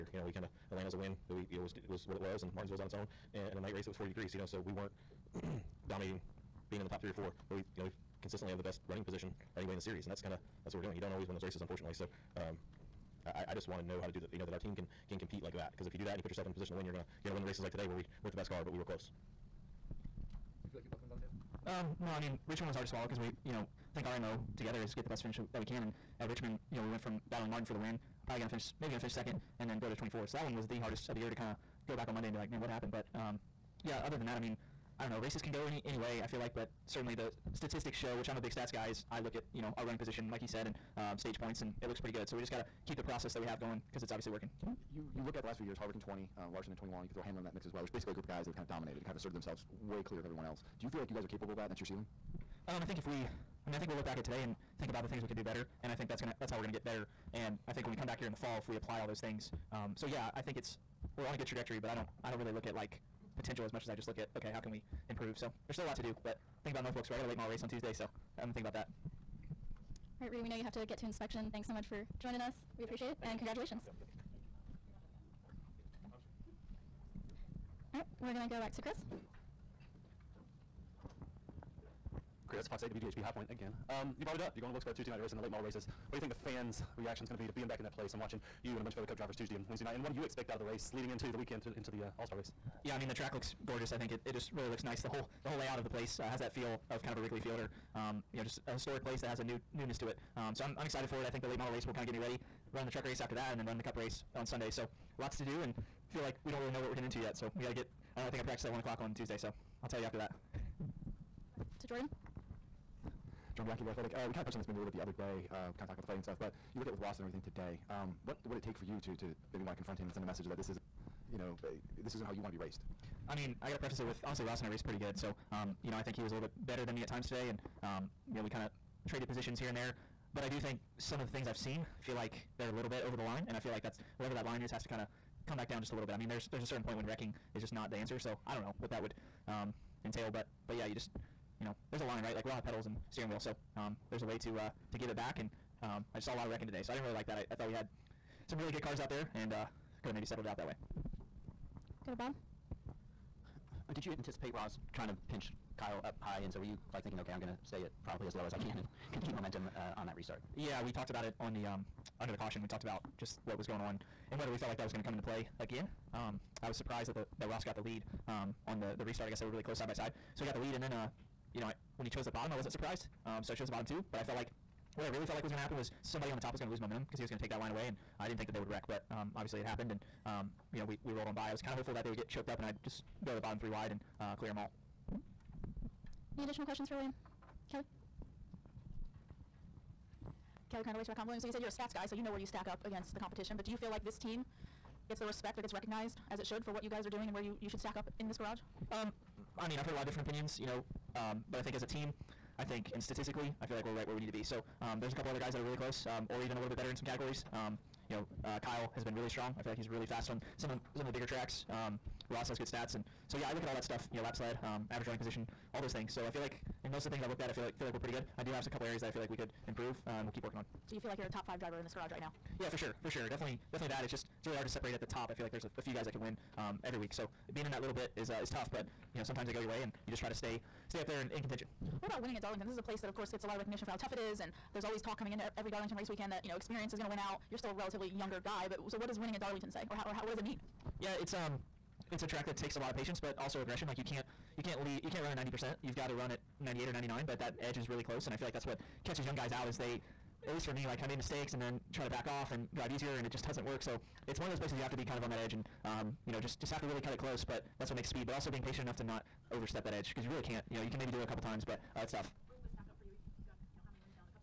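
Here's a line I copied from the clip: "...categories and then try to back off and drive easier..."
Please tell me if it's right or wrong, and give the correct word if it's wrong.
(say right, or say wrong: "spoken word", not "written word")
wrong: "mistakes", not "categories".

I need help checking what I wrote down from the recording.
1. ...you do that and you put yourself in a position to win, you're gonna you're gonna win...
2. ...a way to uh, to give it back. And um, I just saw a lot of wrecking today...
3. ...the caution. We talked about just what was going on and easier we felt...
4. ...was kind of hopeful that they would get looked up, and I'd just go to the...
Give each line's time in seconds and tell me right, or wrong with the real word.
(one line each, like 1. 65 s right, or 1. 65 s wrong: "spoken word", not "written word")
1. 15 s right
2. 144 s right
3. 162 s wrong: "whether", not "easier"
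4. 181 s wrong: "choked", not "looked".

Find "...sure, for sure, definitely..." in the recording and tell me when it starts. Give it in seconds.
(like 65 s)
222 s.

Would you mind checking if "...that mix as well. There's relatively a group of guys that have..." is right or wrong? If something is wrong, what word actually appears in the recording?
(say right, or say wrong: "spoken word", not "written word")
wrong: "basically", not "relatively".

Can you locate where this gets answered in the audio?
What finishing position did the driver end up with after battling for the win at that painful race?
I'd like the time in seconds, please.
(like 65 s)
29 s.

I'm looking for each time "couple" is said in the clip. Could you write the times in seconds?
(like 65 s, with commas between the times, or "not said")
205 s, 218 s, 261 s.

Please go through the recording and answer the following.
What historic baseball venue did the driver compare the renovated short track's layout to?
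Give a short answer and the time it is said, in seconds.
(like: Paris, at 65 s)
Wrigley Field, at 97 s.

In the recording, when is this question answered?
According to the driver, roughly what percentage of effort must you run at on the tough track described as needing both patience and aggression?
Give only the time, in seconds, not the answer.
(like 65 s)
246 s.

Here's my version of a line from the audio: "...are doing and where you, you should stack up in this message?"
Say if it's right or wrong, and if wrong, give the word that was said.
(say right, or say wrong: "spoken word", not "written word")
wrong: "garage", not "message".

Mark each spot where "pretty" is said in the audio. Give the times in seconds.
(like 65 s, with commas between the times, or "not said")
41 s, 124 s, 217 s.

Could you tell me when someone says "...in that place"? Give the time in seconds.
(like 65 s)
87 s.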